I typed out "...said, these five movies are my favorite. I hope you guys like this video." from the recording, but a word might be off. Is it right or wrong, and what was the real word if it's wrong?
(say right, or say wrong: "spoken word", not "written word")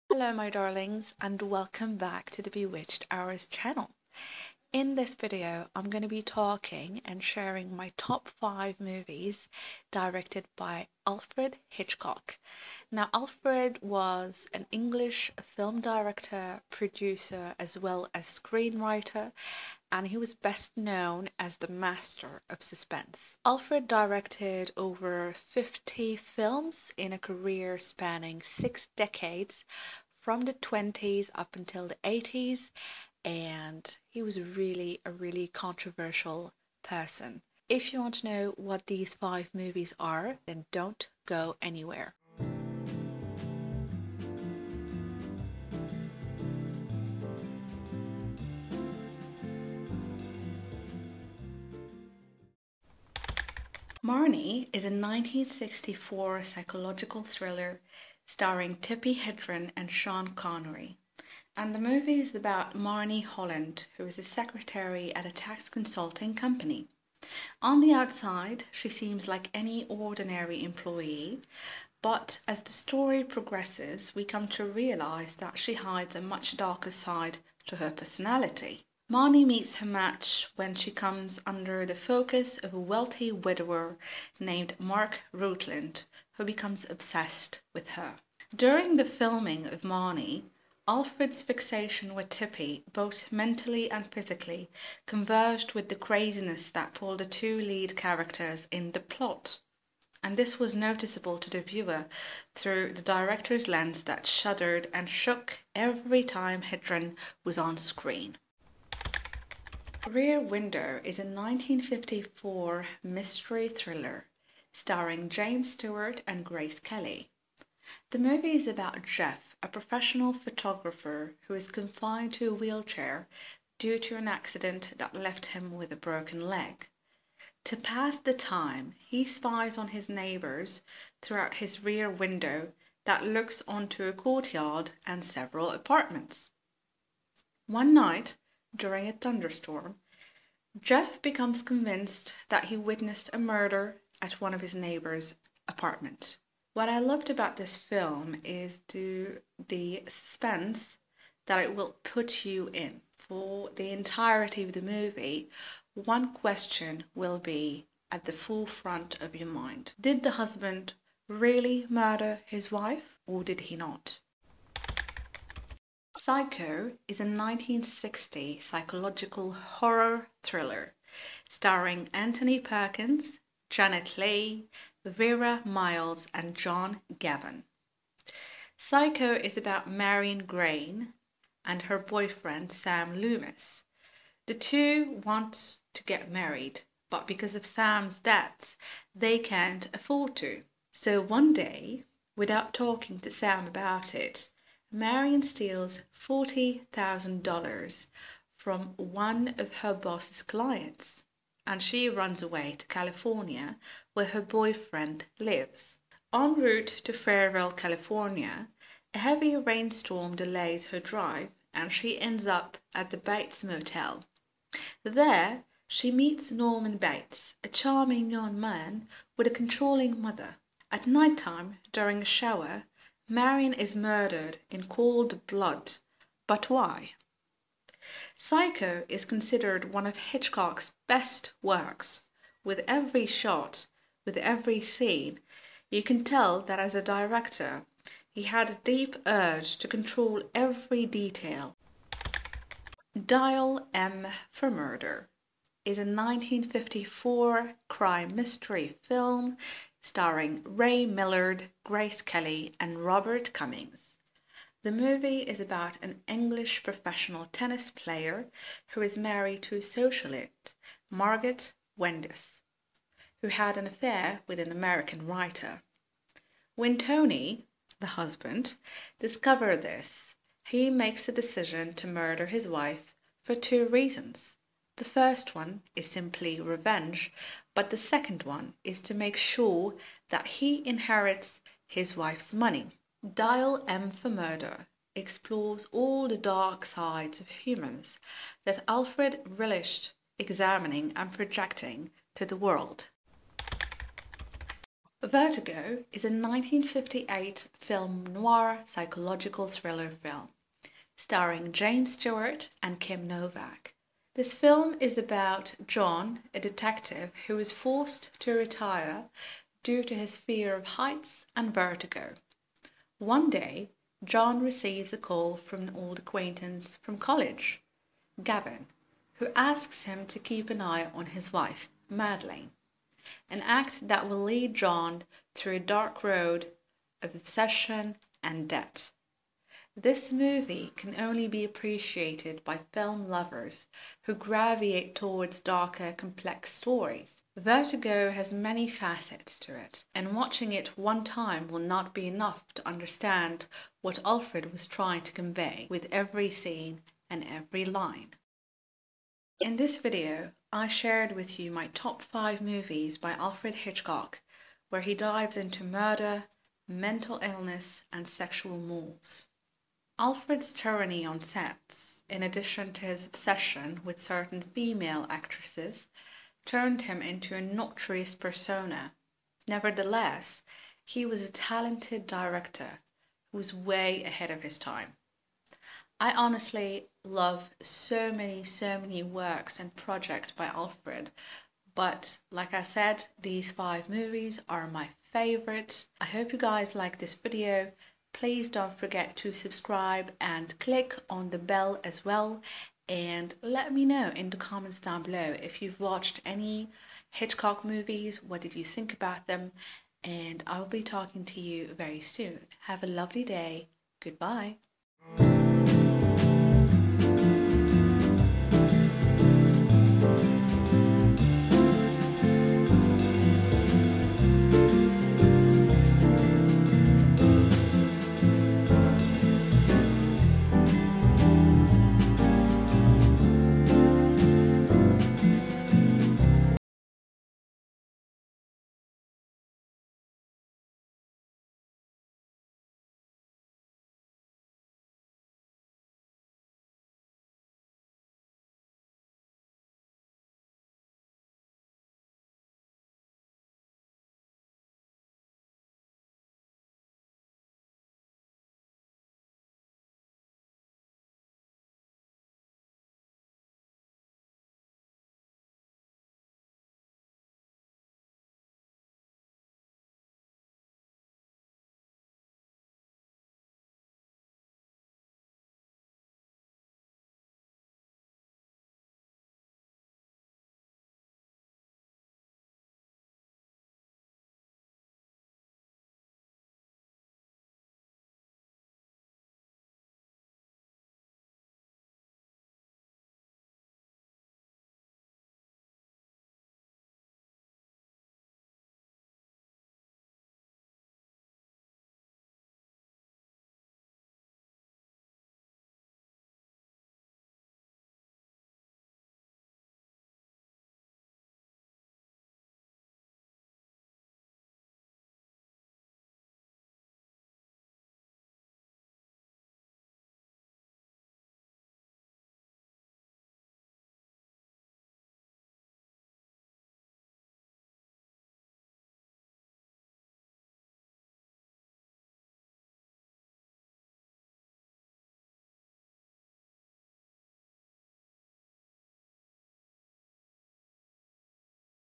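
right.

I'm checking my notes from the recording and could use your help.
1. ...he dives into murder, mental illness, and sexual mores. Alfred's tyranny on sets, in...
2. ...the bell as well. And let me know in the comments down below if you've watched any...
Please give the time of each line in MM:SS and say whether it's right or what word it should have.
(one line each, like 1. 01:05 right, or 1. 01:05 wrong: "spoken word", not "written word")
1. 05:55 right
2. 06:31 right.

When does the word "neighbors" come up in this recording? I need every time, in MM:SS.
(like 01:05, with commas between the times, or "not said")
02:10, 02:24.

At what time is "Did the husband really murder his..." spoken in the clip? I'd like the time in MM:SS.
02:39.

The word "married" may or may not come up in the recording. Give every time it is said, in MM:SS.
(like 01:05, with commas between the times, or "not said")
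03:06, 04:19.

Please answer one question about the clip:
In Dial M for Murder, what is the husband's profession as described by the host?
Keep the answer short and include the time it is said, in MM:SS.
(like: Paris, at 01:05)
Professional tennis player, at 04:16.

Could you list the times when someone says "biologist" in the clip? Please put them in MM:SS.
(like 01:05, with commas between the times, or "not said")
not said.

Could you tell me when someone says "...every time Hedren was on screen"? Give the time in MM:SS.
01:45.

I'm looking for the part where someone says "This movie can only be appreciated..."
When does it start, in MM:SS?
05:30.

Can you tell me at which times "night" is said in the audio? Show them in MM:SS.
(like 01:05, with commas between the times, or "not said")
02:17, 03:41.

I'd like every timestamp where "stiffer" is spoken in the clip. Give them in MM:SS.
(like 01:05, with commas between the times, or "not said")
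not said.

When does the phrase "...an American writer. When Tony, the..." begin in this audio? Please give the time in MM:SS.
04:24.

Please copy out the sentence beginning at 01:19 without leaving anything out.
Marnie meets her match when she comes under the focus of a wealthy widower named Mark Rutland, who becomes obsessed with her.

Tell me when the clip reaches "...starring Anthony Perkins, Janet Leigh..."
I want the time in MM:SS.
02:51.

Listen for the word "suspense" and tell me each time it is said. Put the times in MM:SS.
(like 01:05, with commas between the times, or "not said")
00:22, 02:30.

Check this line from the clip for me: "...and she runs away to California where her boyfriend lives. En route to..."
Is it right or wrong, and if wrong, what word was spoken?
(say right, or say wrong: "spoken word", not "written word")
right.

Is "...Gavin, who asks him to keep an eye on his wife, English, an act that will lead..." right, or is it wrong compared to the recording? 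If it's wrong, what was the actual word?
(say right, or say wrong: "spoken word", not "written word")
wrong: "Madeleine", not "English".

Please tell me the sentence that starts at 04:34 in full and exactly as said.
The first one is simply revenge, but the second one is to make sure that he inherits his wife's money.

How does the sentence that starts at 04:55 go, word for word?
Vertigo is a 1958 film noir psychological thriller film starring James Stewart and Kim Novak.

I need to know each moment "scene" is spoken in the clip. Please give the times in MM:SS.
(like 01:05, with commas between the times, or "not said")
03:54, 05:46.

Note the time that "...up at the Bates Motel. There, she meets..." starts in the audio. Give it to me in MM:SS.
03:32.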